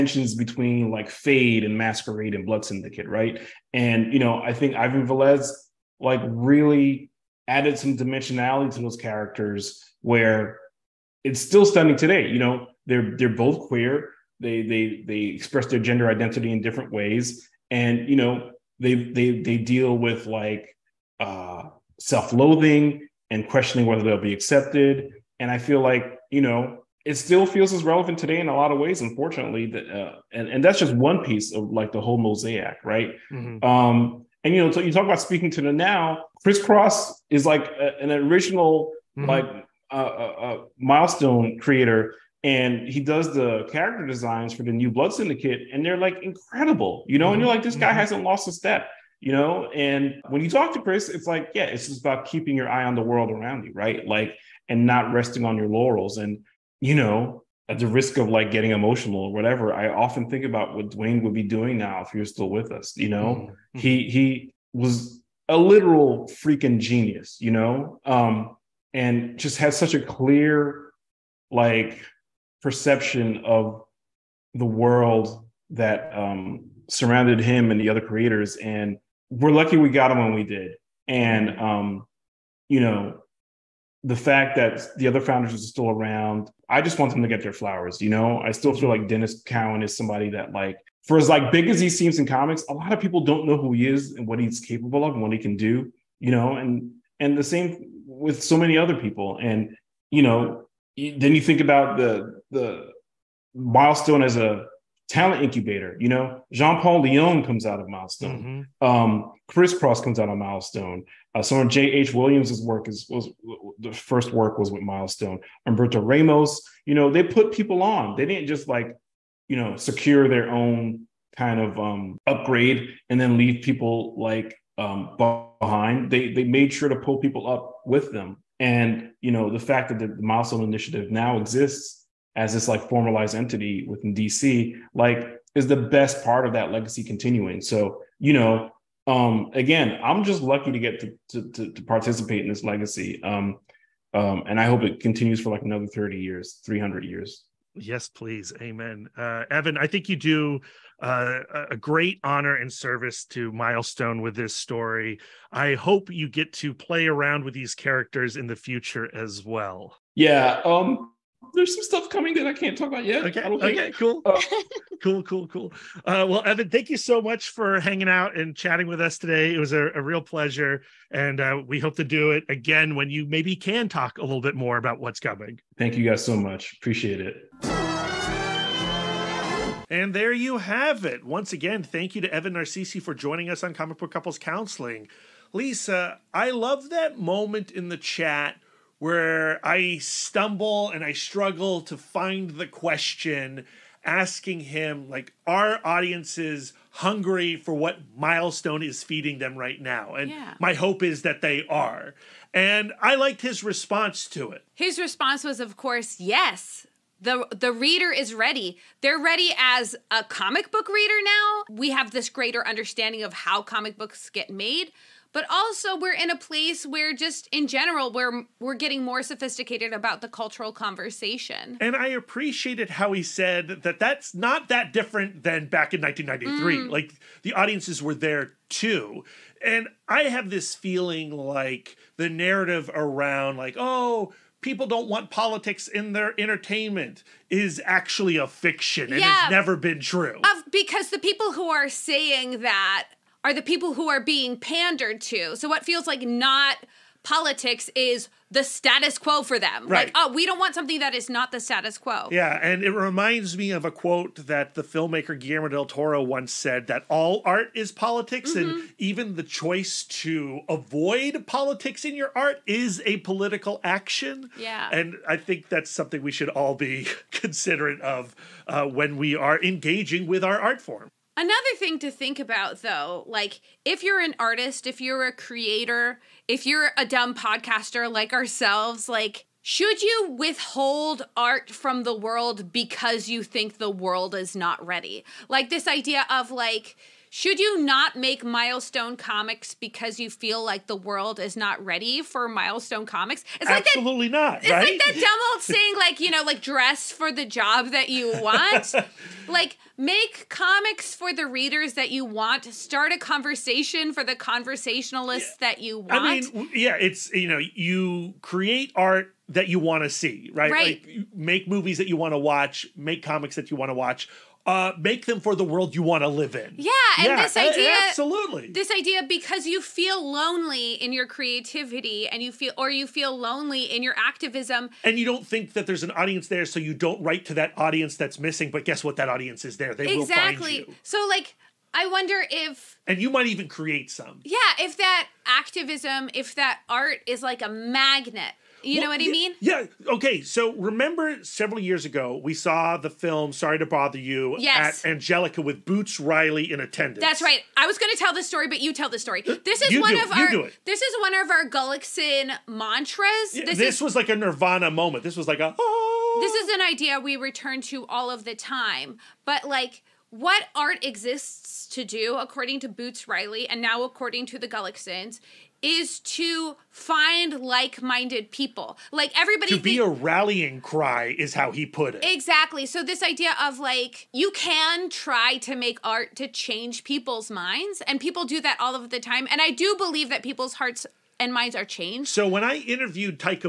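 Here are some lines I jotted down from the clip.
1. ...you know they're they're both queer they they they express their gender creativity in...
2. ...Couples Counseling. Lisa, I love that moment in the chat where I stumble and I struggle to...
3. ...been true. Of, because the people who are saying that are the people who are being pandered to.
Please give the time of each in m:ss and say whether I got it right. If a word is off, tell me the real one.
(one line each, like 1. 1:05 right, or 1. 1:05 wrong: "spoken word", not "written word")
1. 0:12 wrong: "identity", not "creativity"
2. 3:04 right
3. 3:59 right.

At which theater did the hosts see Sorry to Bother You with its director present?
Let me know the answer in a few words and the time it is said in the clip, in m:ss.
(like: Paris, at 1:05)
Angelika, at 5:45.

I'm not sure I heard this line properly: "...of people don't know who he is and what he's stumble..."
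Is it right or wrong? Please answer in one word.
wrong.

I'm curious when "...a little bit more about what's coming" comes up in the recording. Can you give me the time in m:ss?
2:54.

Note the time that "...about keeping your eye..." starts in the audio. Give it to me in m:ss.
0:52.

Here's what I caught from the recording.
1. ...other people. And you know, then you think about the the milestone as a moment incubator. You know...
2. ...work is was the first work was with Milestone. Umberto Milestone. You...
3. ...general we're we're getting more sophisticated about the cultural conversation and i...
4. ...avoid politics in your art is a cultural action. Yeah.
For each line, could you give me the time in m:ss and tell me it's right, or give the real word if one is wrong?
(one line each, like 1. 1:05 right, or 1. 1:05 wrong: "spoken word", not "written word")
1. 1:38 wrong: "talent", not "moment"
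2. 1:52 wrong: "Ramos", not "Milestone"
3. 3:37 right
4. 4:20 wrong: "political", not "cultural".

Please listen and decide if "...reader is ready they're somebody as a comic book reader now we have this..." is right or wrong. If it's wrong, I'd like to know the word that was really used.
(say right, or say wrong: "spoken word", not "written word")
wrong: "ready", not "somebody".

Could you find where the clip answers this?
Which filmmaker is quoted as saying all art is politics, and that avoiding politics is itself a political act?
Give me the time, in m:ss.
4:15.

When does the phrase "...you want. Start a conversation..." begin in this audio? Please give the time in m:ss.
5:02.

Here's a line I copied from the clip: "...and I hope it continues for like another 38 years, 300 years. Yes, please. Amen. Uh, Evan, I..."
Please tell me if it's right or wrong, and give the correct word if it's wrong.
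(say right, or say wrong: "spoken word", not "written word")
wrong: "30", not "38".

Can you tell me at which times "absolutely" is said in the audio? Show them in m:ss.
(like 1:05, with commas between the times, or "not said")
4:53, 5:18.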